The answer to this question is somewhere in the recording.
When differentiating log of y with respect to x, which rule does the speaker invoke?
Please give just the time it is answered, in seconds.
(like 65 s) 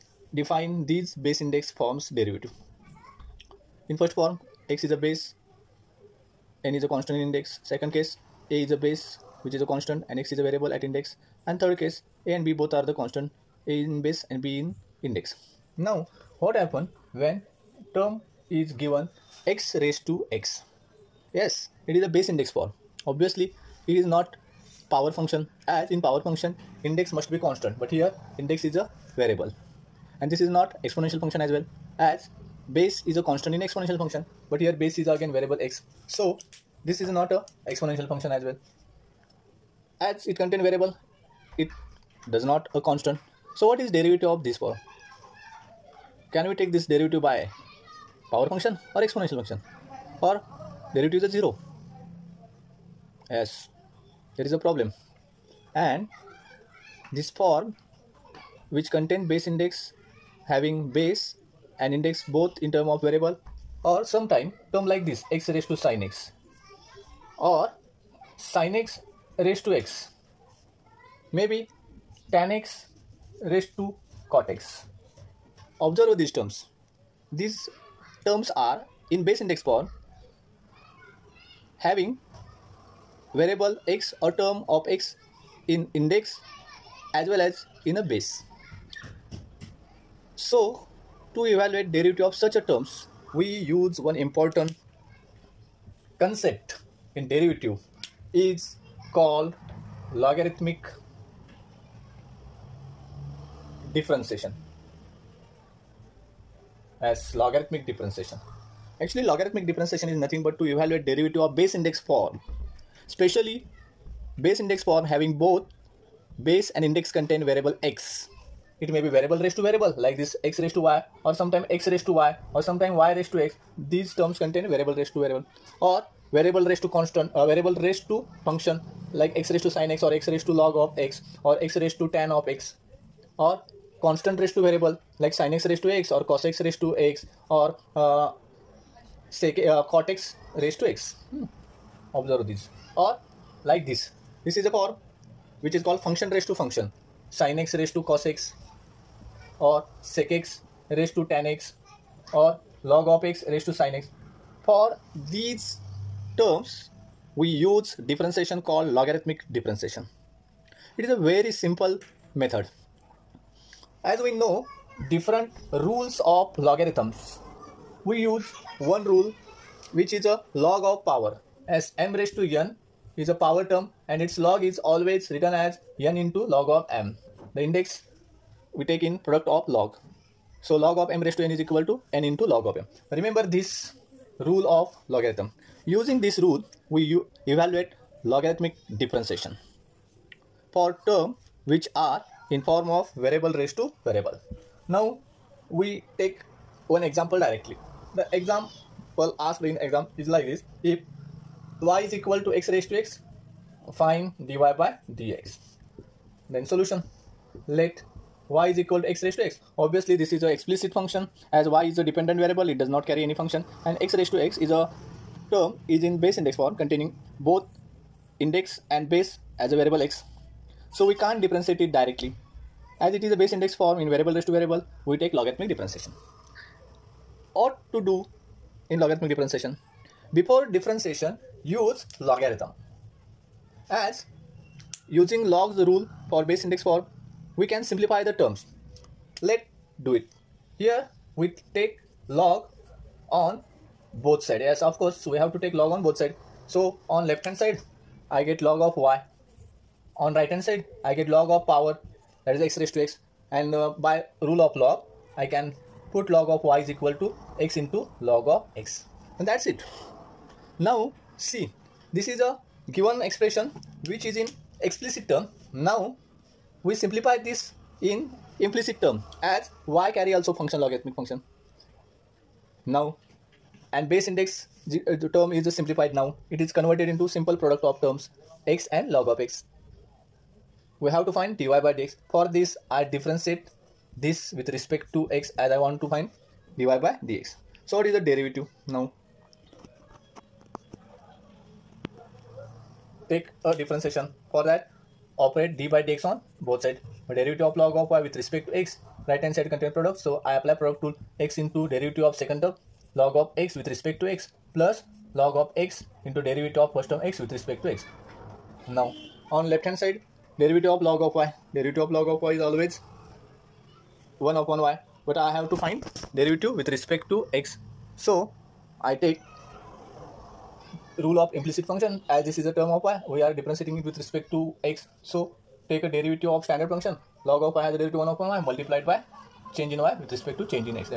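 321 s.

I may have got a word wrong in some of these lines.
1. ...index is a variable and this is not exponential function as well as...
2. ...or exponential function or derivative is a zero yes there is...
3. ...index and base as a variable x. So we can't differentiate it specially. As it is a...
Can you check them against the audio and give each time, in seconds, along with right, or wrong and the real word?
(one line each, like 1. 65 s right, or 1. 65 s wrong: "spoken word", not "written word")
1. 28 s right
2. 48 s right
3. 218 s wrong: "directly", not "specially".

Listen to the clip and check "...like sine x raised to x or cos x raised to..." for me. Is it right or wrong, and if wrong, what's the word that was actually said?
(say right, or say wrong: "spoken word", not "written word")
right.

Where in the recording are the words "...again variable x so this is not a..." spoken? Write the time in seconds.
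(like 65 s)
35 s.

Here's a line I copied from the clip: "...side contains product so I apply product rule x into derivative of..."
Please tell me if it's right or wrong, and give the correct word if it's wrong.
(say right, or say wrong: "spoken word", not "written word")
right.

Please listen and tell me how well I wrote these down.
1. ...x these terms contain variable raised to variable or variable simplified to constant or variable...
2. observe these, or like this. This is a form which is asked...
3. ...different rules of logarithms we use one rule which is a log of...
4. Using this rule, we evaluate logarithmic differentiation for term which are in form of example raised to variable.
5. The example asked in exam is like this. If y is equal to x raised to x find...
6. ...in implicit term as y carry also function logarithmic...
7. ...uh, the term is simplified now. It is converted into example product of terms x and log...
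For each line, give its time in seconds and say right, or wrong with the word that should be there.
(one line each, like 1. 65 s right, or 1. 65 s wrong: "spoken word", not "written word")
1. 123 s wrong: "raised", not "simplified"
2. 142 s wrong: "called", not "asked"
3. 165 s right
4. 185 s wrong: "variable", not "example"
5. 198 s right
6. 268 s right
7. 274 s wrong: "simple", not "example".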